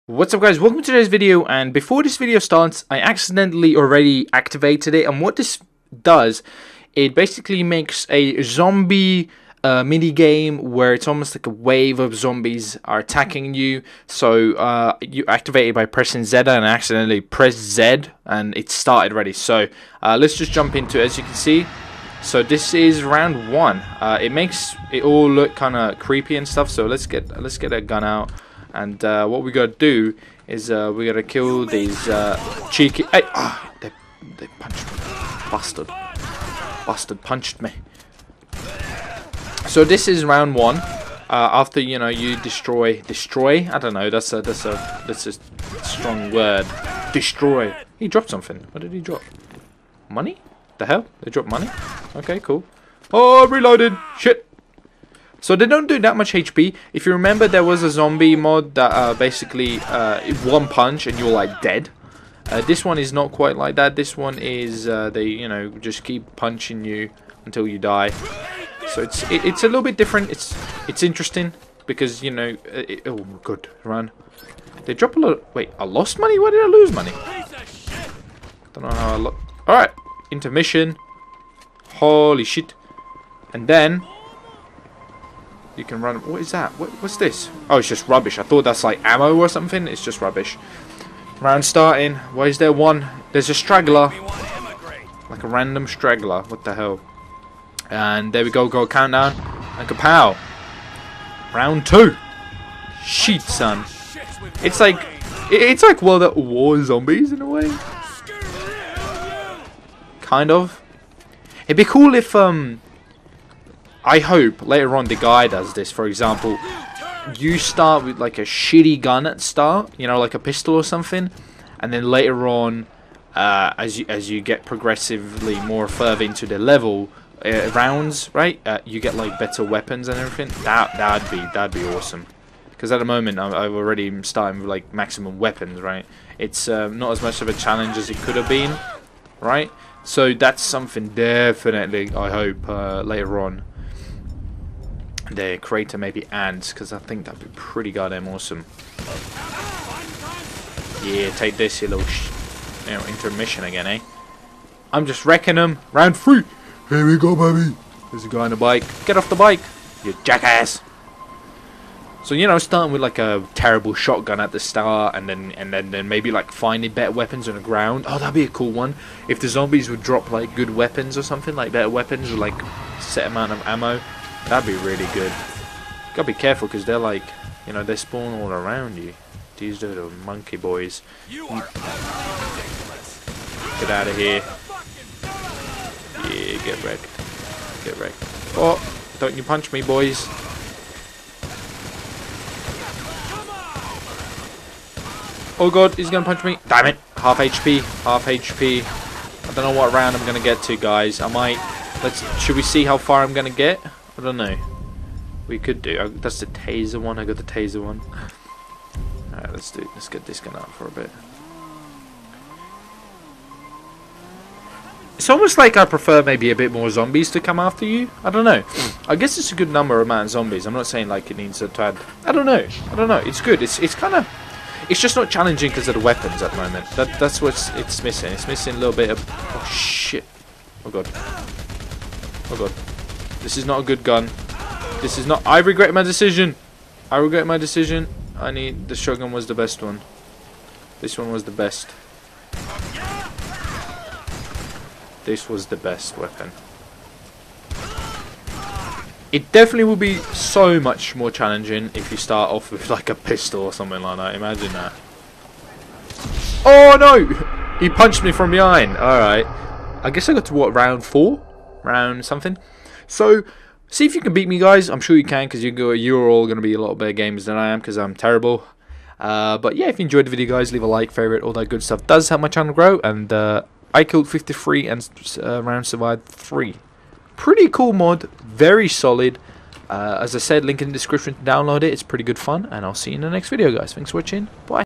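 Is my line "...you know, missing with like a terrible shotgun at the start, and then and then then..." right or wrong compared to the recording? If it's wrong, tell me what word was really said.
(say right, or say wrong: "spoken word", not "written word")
wrong: "starting", not "missing".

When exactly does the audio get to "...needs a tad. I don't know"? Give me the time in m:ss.
3:41.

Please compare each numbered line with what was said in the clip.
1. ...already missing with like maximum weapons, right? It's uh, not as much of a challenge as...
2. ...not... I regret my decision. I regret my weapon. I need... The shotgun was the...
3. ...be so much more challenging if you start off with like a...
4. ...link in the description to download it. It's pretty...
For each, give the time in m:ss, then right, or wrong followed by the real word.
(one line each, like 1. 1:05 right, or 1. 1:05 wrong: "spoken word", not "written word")
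1. 2:13 wrong: "starting", not "missing"
2. 3:55 wrong: "decision", not "weapon"
3. 4:09 right
4. 4:40 right.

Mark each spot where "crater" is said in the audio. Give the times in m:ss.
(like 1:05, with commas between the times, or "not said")
2:25.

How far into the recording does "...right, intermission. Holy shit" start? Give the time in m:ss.
1:19.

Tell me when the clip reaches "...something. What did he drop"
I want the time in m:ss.
0:48.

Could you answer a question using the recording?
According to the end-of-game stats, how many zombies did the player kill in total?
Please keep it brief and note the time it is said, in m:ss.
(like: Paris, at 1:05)
53, at 4:34.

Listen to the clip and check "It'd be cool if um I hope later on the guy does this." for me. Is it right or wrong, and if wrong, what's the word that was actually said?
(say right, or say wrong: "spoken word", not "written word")
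right.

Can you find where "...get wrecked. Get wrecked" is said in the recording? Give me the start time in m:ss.
3:06.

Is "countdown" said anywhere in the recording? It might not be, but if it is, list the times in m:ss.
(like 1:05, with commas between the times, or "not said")
1:38.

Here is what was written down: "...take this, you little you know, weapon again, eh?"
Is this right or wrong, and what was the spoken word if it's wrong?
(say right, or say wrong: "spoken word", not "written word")
wrong: "intermission", not "weapon".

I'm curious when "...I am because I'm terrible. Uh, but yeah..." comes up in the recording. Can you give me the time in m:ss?
4:27.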